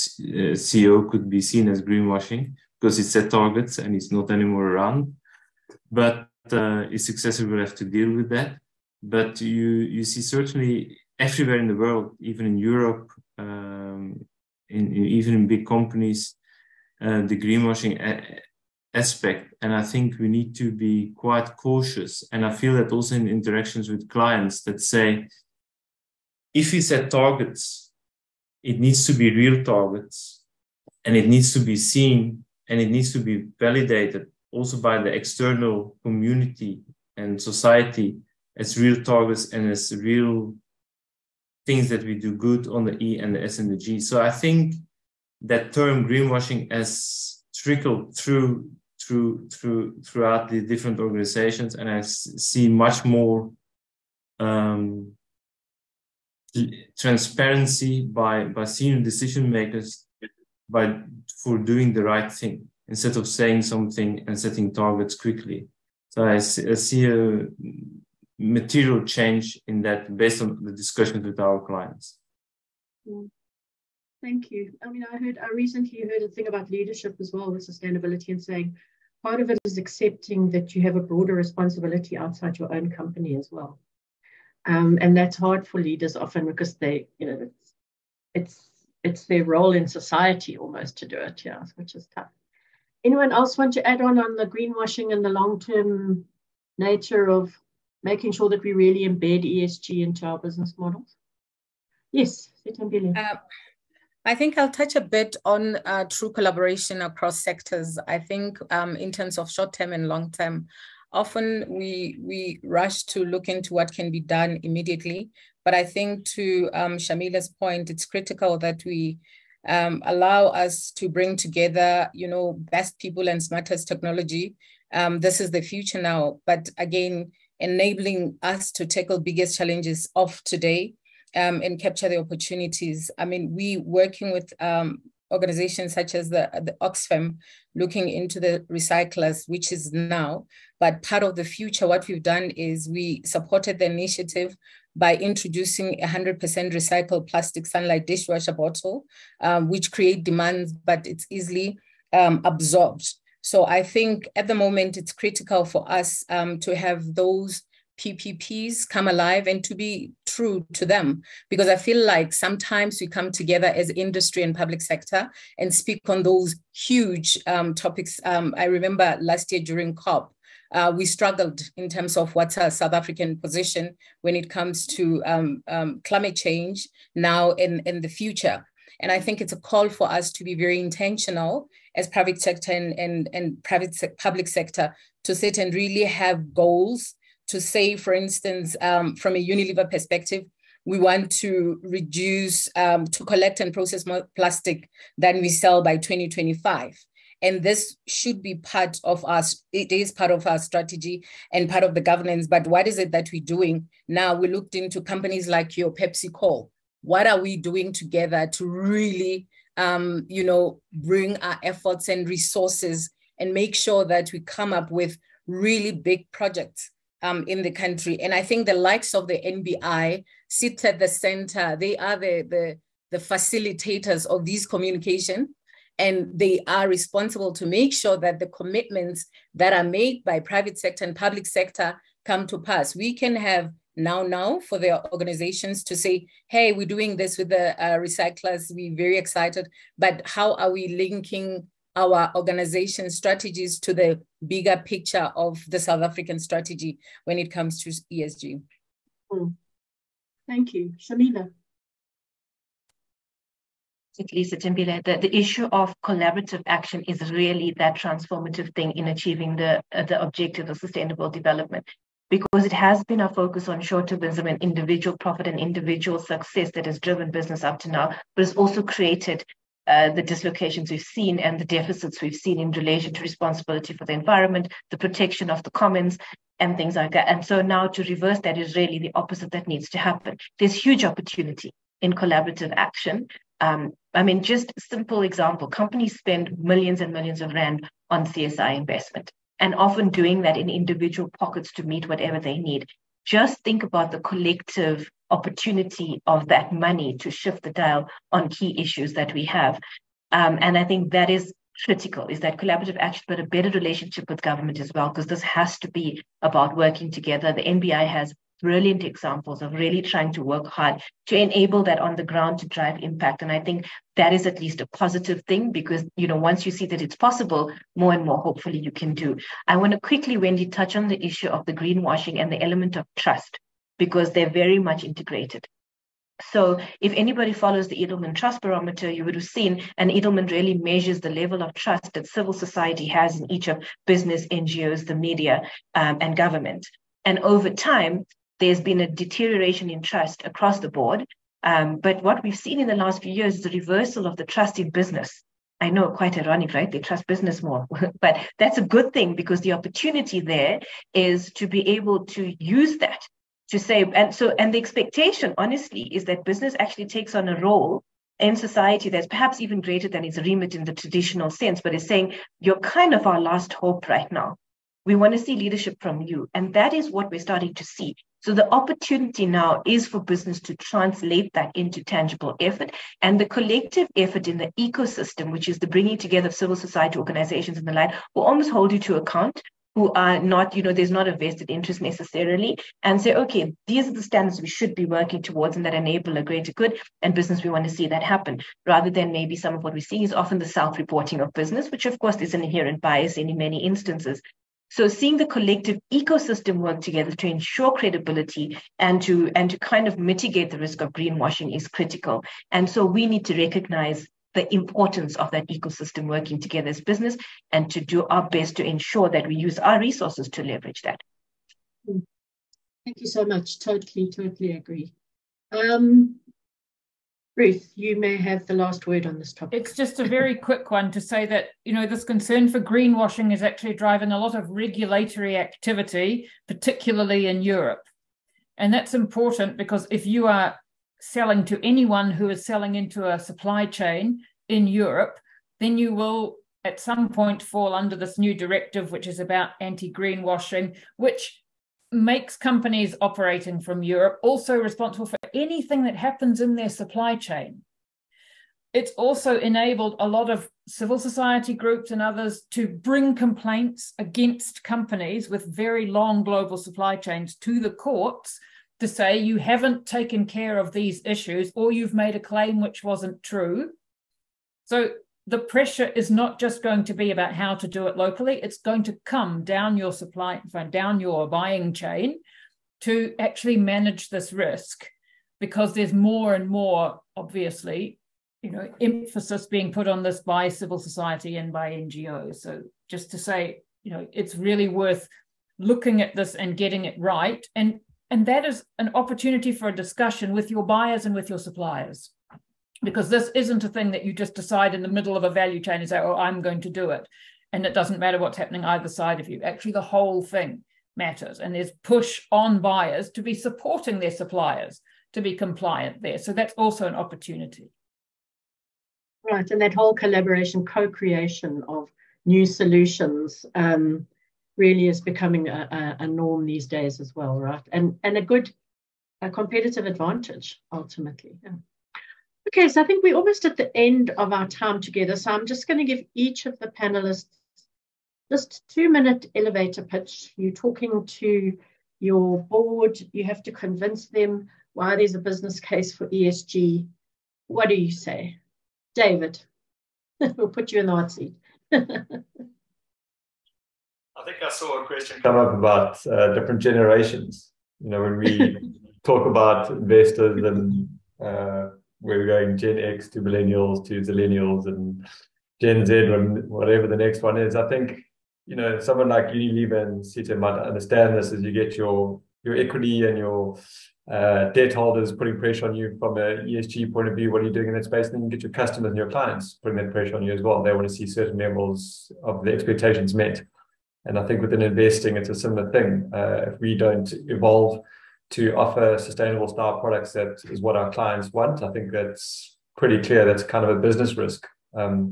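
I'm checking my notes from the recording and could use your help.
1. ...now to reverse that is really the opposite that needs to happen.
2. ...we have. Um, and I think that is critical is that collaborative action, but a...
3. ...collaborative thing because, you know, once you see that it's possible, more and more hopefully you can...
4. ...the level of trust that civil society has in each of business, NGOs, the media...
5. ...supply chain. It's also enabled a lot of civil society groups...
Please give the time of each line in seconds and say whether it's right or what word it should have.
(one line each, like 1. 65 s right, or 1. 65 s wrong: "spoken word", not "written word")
1. 277 s right
2. 299 s right
3. 314 s wrong: "positive", not "collaborative"
4. 331 s right
5. 446 s right.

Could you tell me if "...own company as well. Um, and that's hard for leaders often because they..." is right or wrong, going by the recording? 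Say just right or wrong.
right.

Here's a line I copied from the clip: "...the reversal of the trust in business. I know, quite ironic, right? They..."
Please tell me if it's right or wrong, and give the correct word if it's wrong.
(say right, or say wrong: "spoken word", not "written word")
right.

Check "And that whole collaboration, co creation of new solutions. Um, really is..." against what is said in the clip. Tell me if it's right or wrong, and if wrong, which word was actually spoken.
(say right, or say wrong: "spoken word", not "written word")
right.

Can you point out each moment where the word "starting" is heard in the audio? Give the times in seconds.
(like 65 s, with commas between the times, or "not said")
367 s.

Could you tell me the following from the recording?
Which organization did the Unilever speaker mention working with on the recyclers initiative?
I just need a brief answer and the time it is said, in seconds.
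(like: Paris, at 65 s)
Oxfam, at 136 s.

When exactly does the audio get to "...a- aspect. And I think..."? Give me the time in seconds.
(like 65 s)
17 s.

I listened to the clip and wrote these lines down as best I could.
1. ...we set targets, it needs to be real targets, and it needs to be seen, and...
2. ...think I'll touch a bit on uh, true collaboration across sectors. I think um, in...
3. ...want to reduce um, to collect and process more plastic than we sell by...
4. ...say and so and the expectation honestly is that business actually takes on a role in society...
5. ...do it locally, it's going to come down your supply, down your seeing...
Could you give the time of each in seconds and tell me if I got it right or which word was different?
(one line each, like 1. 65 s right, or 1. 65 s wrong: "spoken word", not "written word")
1. 26 s right
2. 104 s right
3. 190 s right
4. 353 s right
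5. 467 s wrong: "buying", not "seeing".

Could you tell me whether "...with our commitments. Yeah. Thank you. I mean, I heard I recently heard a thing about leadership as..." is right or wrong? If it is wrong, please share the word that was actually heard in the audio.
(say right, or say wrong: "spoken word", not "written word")
wrong: "clients", not "commitments".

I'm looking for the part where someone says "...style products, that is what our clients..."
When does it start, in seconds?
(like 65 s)
579 s.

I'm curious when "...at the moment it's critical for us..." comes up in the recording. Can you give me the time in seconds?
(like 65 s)
154 s.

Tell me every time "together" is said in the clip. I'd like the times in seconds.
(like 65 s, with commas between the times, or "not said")
121 s, 163 s, 207 s, 307 s, 376 s, 396 s, 406 s, 524 s.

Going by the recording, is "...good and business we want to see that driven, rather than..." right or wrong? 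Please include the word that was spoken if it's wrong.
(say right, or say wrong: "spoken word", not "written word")
wrong: "happen", not "driven".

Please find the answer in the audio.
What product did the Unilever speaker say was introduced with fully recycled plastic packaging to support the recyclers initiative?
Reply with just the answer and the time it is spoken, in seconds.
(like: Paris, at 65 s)
Sunlight dishwasher bottle, at 147 s.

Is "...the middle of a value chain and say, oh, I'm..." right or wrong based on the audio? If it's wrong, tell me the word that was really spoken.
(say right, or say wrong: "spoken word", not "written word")
right.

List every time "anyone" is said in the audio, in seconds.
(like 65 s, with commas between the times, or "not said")
93 s, 431 s.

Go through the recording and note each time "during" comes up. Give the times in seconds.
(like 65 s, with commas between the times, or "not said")
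169 s.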